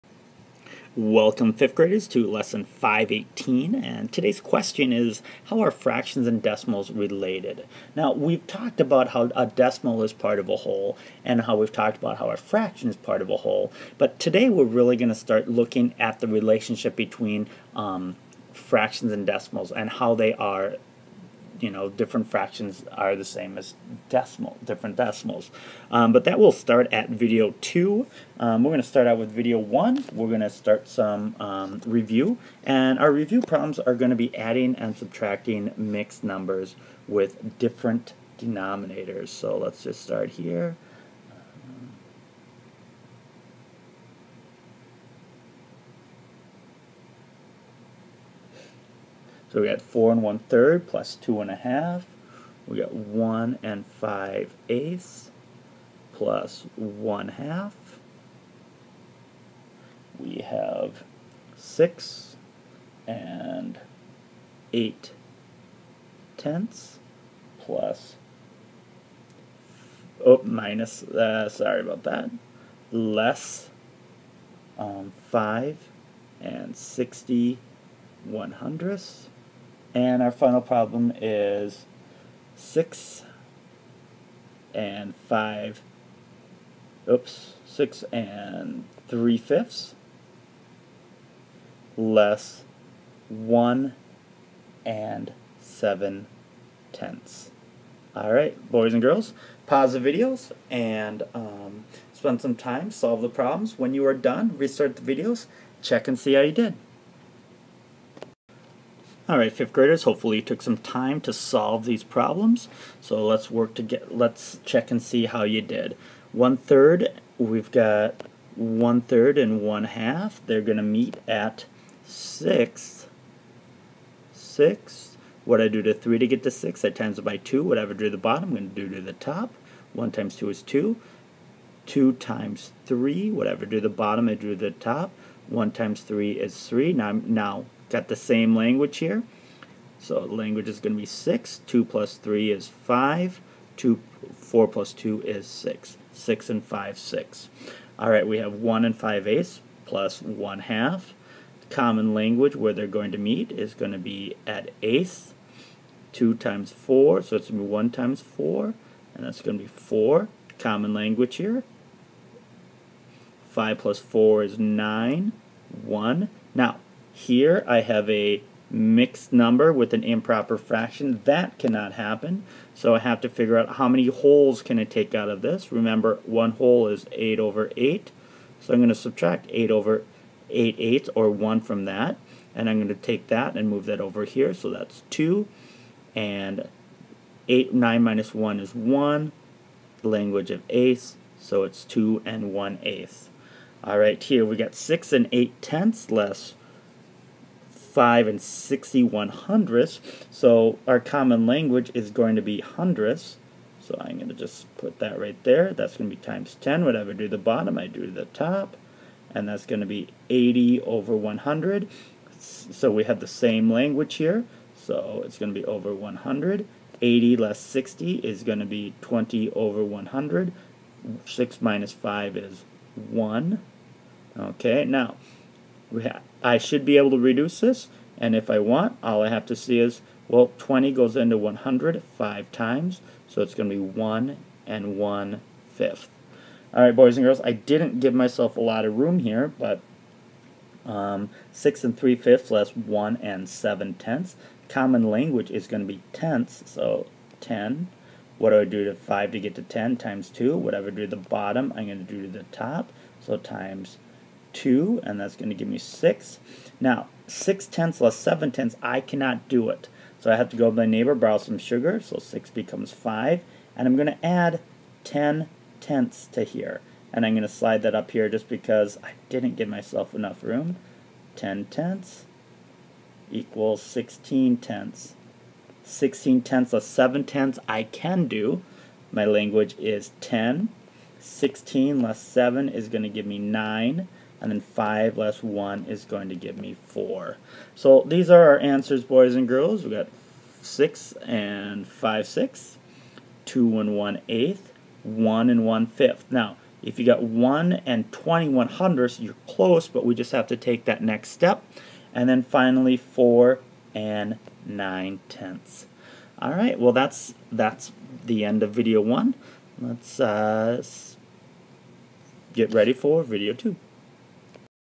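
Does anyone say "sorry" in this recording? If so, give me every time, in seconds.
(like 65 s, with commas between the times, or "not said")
71 s.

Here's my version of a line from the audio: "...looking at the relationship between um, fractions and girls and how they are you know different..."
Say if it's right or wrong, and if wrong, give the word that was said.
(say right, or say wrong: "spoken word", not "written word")
wrong: "decimals", not "girls".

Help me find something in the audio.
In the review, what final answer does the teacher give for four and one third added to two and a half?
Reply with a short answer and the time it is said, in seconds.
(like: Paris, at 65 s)
6 and 5 sixths, at 146 s.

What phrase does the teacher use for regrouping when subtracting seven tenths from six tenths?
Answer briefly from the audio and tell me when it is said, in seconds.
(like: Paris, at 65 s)
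borrow some sugar, at 261 s.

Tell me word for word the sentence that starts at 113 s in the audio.
So let's work to get, let's check and see how you did.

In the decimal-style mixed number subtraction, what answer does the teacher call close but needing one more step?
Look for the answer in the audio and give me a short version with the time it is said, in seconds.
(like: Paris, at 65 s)
1 and 21 hundredths, at 297 s.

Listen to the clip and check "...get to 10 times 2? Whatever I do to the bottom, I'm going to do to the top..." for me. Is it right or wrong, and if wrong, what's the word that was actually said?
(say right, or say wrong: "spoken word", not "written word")
right.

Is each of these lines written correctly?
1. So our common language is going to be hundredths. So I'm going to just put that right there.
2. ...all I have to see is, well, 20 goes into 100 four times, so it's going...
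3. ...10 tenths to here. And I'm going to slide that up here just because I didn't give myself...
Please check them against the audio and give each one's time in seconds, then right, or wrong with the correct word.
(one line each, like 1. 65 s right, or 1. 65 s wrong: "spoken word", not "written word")
1. 200 s right
2. 229 s wrong: "five", not "four"
3. 265 s right.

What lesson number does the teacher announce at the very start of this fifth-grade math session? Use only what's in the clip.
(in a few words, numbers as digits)
518.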